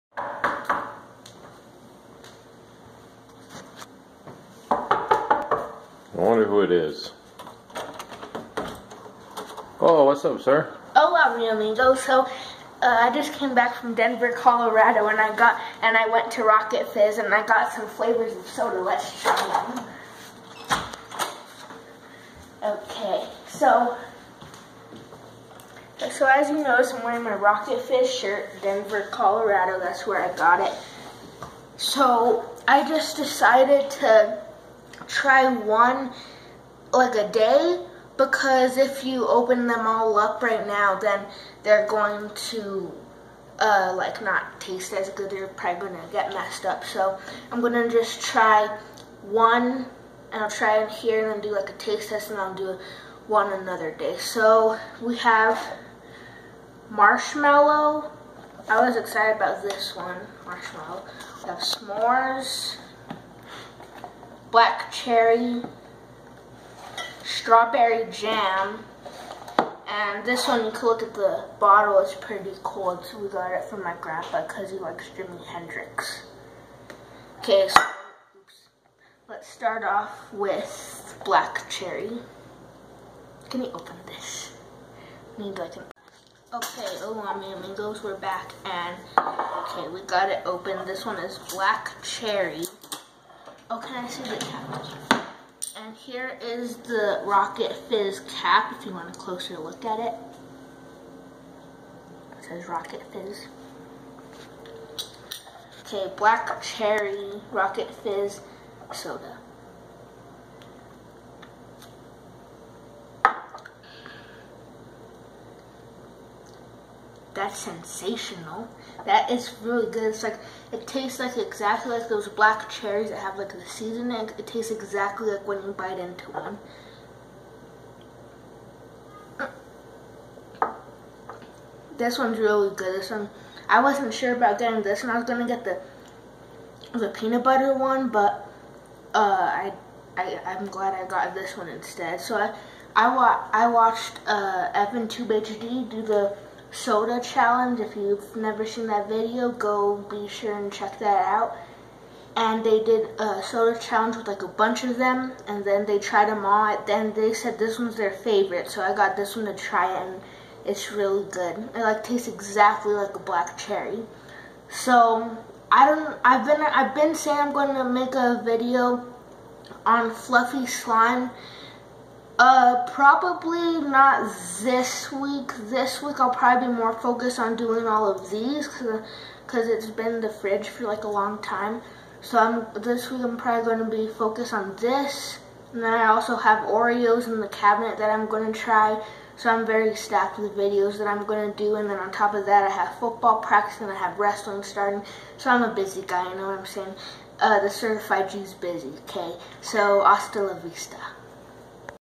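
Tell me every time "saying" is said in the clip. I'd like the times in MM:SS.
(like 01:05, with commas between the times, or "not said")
02:47, 03:16.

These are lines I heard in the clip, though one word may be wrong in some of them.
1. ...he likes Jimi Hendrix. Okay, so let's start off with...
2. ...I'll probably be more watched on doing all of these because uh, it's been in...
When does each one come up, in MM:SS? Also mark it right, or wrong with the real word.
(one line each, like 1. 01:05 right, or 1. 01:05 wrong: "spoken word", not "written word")
1. 01:14 right
2. 02:56 wrong: "focused", not "watched".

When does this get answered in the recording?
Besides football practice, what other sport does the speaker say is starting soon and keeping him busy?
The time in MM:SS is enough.
03:14.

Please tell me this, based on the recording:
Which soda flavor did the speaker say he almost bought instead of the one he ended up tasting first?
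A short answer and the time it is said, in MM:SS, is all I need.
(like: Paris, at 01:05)
peanut butter, at 02:17.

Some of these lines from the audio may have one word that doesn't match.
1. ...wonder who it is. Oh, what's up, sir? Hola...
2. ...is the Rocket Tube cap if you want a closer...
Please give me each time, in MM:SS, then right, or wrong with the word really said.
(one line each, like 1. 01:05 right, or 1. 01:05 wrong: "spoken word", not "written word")
1. 00:06 right
2. 01:36 wrong: "Fizz", not "Tube".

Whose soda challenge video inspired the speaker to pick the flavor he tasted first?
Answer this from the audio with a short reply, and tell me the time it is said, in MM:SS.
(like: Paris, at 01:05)
Evan Tube HD, at 02:24.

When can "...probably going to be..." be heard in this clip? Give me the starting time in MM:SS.
03:03.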